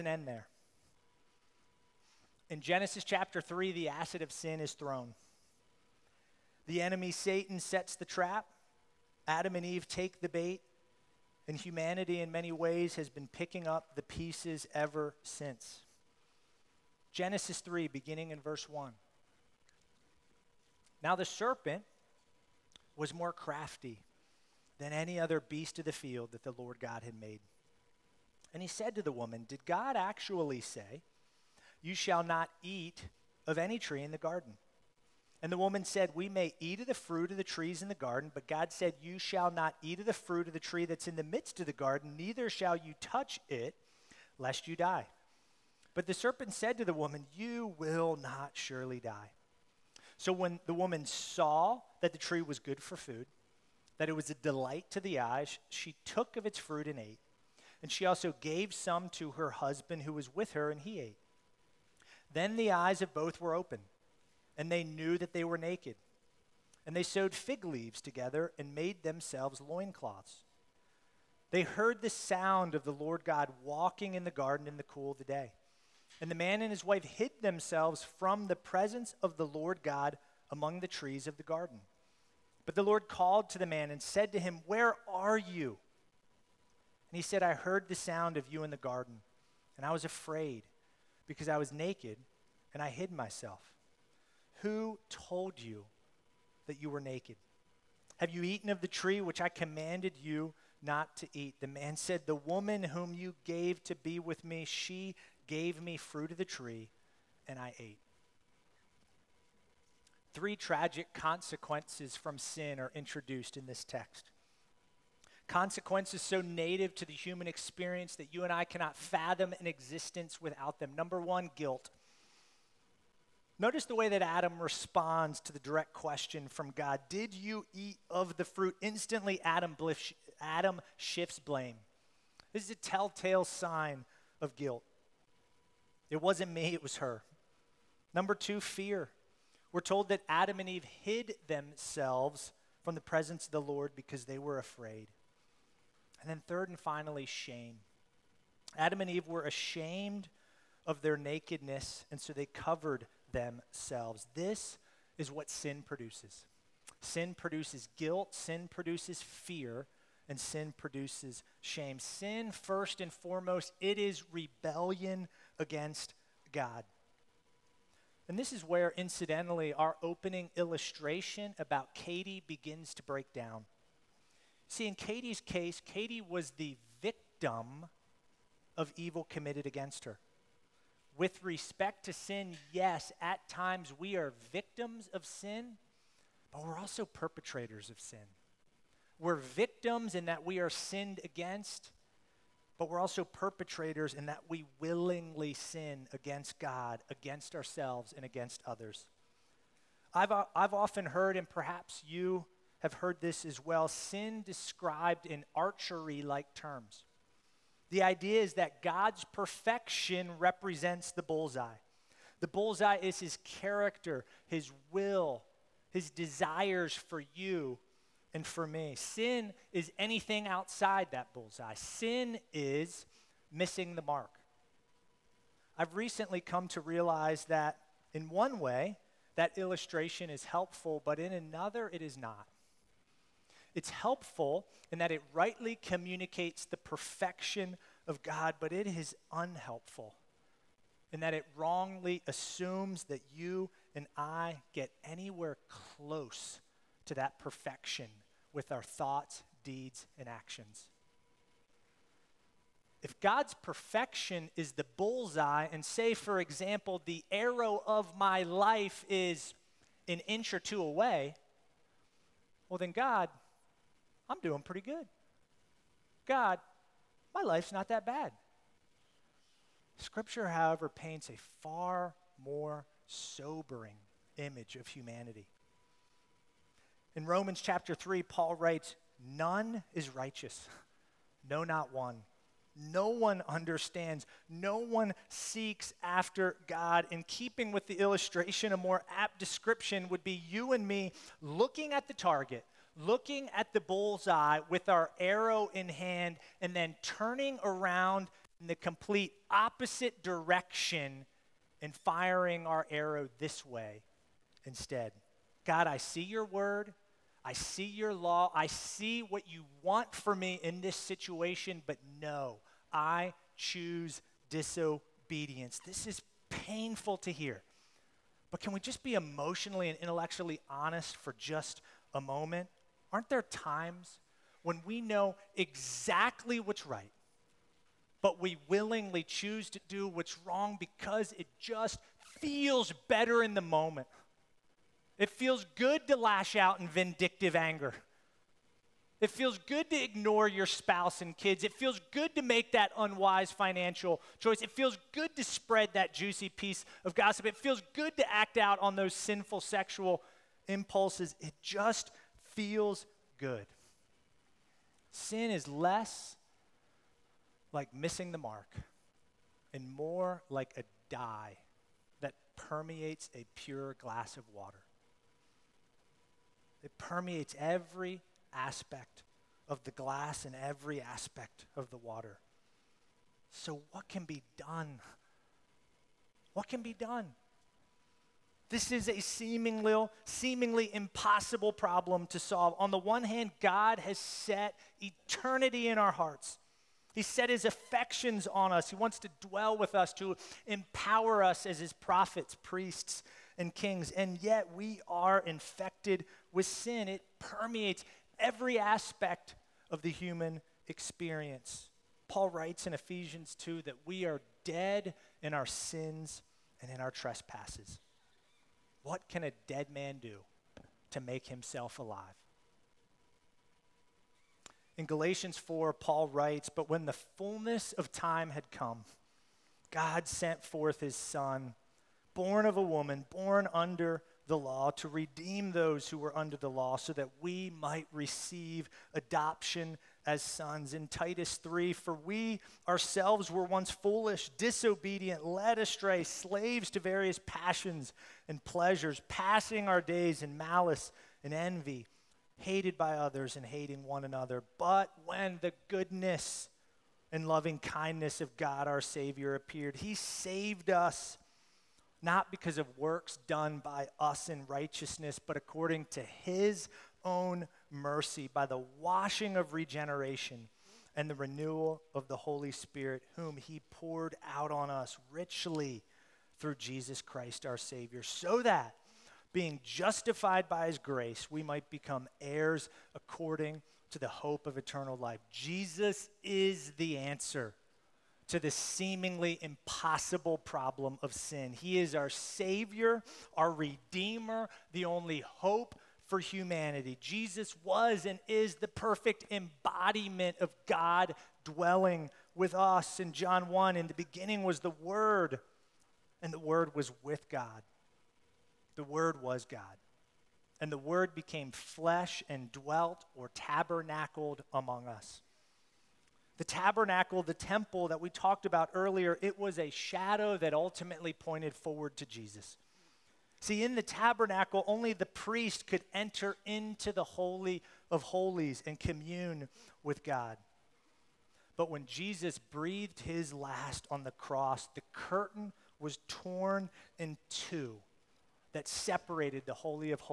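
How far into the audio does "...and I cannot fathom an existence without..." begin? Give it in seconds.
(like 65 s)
118 s.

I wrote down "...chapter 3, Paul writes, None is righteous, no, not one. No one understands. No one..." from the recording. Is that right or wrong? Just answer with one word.
right.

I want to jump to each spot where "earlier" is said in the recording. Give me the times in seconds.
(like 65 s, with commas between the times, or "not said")
508 s.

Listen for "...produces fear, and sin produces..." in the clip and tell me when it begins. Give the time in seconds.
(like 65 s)
158 s.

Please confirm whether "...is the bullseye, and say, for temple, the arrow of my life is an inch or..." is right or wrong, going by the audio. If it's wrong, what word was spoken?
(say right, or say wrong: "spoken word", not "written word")
wrong: "example", not "temple".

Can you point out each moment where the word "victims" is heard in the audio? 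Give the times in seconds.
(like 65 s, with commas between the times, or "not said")
177 s, 184 s, 189 s.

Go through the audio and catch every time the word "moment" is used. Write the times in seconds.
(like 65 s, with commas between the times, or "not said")
322 s, 333 s.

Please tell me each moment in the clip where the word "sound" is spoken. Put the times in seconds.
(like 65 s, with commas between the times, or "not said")
72 s, 87 s.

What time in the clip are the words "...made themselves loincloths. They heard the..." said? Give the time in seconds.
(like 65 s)
68 s.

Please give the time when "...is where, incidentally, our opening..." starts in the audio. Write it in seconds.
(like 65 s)
168 s.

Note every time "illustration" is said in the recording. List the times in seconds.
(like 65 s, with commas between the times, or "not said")
170 s, 229 s, 287 s.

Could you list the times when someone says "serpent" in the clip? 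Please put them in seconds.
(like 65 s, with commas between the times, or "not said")
21 s, 46 s.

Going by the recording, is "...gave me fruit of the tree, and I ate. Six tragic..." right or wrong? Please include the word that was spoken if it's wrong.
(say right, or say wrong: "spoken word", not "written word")
wrong: "Three", not "Six".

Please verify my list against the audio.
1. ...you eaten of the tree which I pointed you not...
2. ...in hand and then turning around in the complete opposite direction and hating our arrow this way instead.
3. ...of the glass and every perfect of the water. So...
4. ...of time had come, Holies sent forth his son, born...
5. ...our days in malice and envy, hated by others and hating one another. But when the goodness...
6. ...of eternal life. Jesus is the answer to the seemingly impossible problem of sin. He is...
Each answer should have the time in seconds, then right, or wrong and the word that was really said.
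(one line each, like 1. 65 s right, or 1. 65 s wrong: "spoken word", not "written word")
1. 98 s wrong: "commanded", not "pointed"
2. 295 s wrong: "firing", not "hating"
3. 369 s wrong: "aspect", not "perfect"
4. 417 s wrong: "God", not "Holies"
5. 439 s right
6. 474 s right.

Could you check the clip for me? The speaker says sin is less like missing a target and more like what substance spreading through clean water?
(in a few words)
A dye.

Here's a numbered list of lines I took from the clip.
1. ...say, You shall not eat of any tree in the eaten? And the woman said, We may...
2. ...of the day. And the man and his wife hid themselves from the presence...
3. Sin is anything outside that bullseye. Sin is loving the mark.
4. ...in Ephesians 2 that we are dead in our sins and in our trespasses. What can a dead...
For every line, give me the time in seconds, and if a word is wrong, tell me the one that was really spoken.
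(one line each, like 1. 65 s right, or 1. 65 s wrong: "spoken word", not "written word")
1. 30 s wrong: "garden", not "eaten"
2. 75 s right
3. 218 s wrong: "missing", not "loving"
4. 402 s right.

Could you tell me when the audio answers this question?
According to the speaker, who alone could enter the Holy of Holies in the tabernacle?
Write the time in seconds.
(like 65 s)
515 s.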